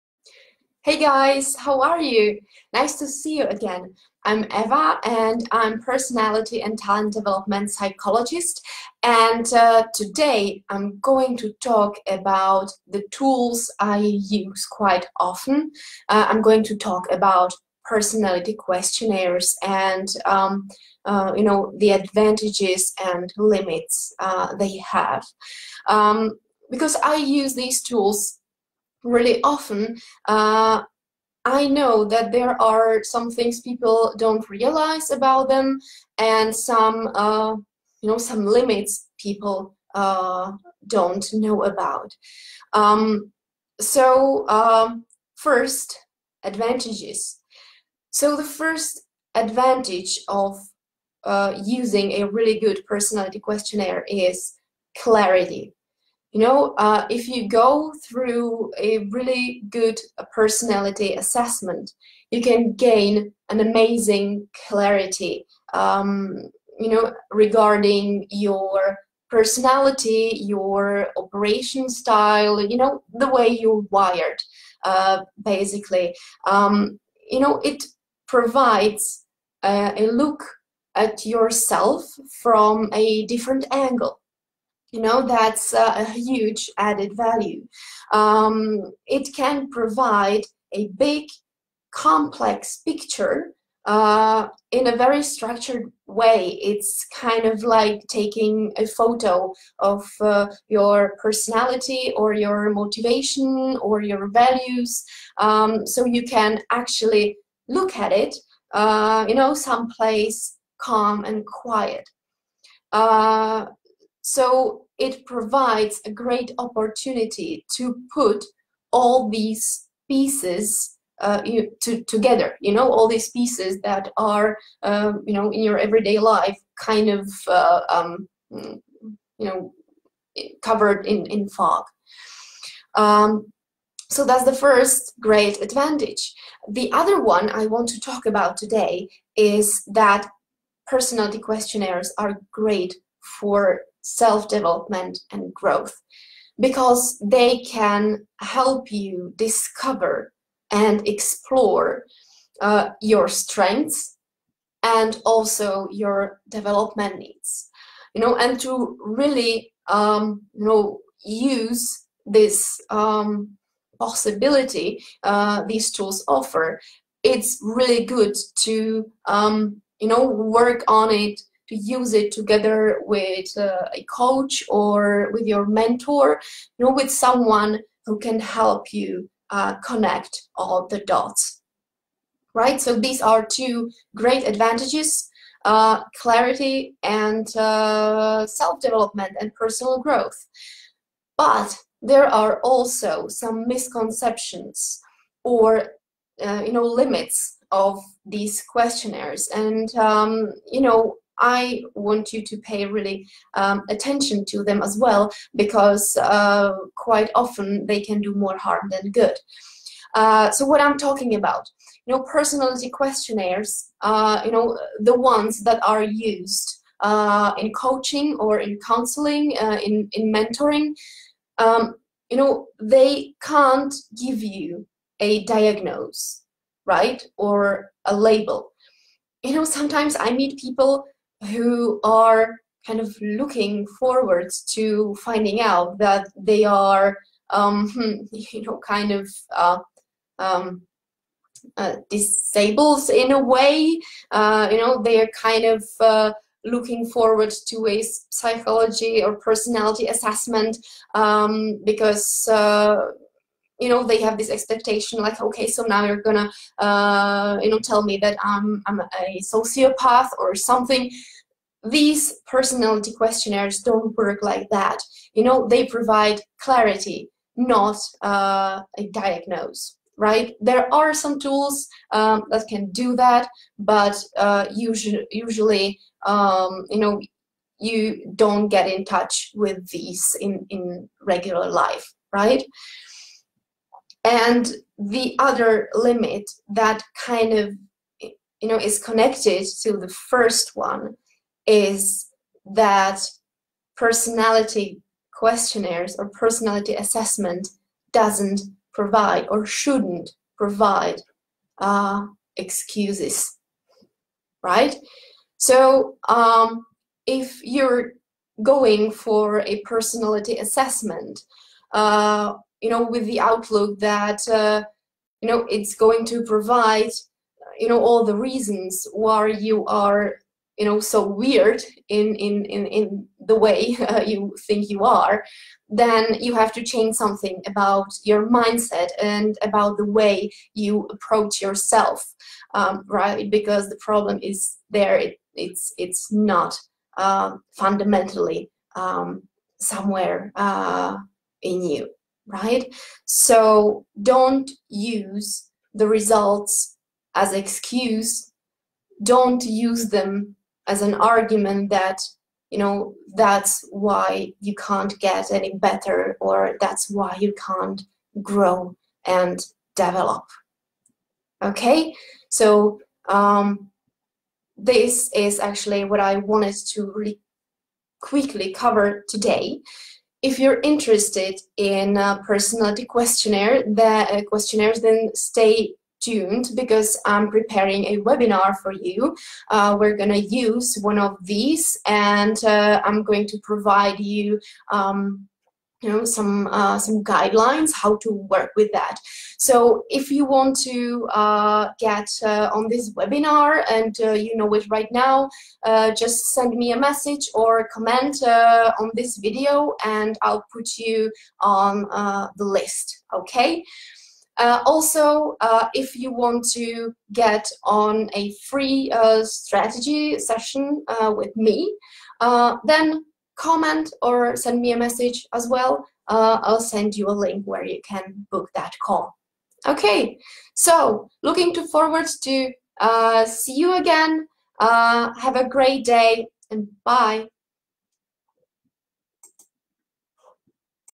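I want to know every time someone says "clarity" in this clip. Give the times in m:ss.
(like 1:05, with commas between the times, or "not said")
0:54, 1:04, 3:06, 4:26.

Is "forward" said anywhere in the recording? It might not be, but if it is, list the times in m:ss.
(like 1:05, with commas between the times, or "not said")
3:53, 4:07, 7:01.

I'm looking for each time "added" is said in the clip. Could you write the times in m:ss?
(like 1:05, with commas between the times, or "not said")
1:26.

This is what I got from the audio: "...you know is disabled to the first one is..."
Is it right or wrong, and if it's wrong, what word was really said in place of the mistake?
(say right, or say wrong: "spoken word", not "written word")
wrong: "connected", not "disabled".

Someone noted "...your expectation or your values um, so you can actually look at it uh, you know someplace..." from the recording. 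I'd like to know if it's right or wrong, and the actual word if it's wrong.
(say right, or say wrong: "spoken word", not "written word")
wrong: "motivation", not "expectation".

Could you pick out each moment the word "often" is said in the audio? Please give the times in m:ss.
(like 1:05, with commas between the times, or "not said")
0:15, 0:29, 3:27.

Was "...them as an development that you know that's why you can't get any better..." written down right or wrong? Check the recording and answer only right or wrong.
wrong.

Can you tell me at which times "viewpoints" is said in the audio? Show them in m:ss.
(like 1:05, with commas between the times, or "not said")
not said.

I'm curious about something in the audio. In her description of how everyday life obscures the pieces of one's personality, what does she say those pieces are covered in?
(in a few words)
Fog.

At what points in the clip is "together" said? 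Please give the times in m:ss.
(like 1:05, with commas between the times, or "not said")
2:02, 2:52.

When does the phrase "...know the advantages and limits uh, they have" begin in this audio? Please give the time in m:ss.
0:21.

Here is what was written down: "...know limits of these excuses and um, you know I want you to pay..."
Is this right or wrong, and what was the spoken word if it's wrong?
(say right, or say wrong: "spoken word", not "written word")
wrong: "questionnaires", not "excuses".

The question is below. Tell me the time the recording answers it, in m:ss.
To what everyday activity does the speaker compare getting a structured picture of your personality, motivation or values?
1:38.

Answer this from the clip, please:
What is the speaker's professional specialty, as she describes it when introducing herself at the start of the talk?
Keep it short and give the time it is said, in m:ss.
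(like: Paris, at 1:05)
Personality and talent development psychologist, at 0:05.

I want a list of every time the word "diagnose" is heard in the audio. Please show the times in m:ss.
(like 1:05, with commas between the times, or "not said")
3:45, 4:29.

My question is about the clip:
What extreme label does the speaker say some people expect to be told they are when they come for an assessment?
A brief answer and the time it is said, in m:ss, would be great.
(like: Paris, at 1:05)
Sociopath, at 4:19.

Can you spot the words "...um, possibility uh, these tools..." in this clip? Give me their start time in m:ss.
2:42.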